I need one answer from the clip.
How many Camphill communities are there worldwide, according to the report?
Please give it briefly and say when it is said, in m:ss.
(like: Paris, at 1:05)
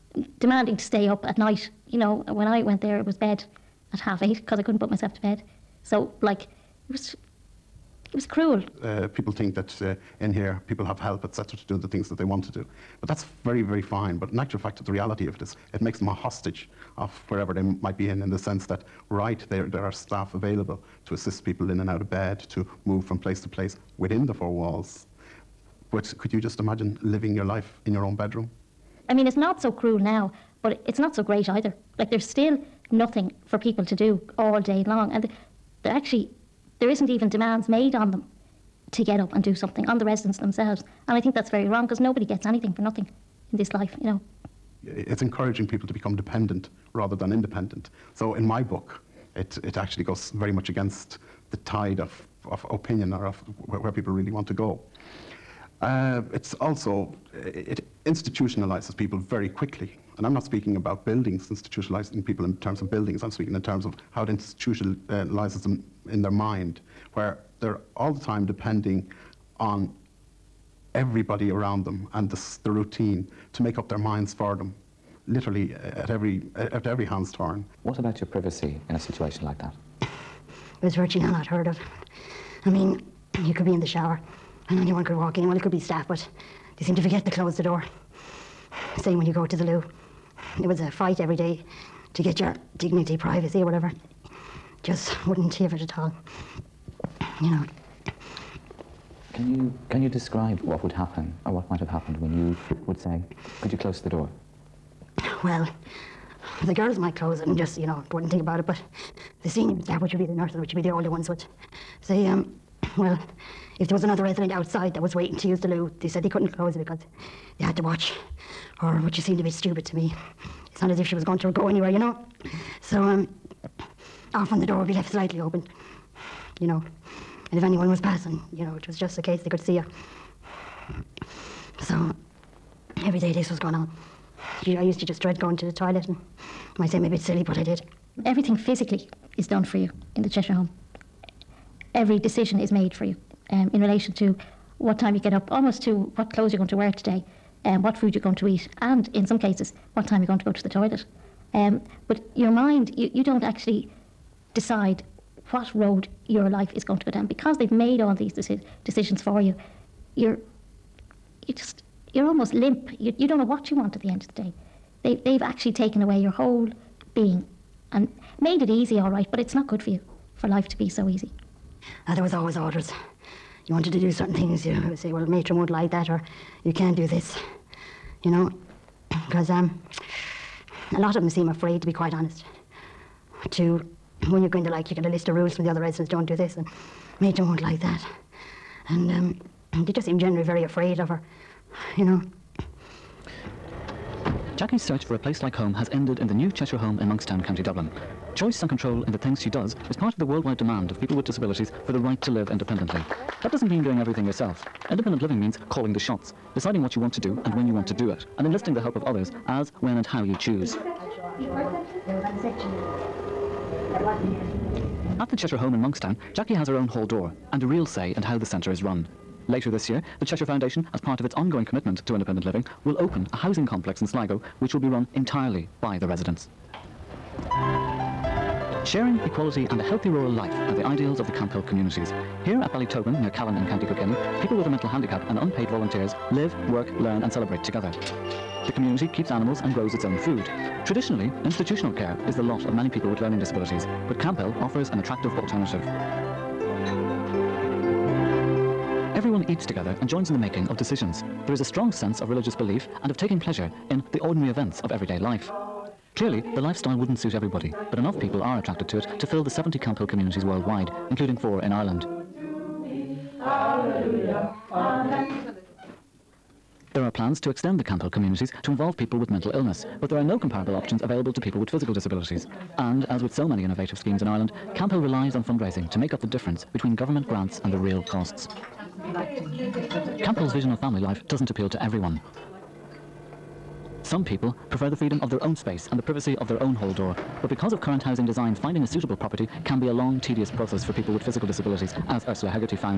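70, at 4:19.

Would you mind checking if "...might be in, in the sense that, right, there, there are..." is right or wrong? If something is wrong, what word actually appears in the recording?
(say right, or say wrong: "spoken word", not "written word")
right.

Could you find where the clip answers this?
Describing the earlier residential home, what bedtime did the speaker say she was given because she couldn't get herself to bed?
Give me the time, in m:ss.
0:03.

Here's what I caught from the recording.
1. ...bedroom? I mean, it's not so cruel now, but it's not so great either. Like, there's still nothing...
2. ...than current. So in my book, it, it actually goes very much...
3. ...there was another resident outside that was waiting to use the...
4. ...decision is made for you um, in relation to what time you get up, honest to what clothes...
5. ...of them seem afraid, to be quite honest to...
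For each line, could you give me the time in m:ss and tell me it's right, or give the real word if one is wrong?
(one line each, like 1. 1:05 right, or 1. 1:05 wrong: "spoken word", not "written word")
1. 0:28 right
2. 0:47 wrong: "independent", not "current"
3. 1:53 right
4. 2:22 wrong: "almost", not "honest"
5. 3:01 right.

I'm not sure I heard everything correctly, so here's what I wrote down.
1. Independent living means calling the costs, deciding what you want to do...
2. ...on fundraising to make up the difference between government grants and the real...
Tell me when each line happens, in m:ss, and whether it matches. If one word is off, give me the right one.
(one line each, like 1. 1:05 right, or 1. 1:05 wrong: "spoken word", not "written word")
1. 3:24 wrong: "shots", not "costs"
2. 4:35 right.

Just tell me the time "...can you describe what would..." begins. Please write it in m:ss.
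1:39.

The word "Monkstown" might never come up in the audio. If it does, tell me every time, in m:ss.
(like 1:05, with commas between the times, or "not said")
3:17, 3:35.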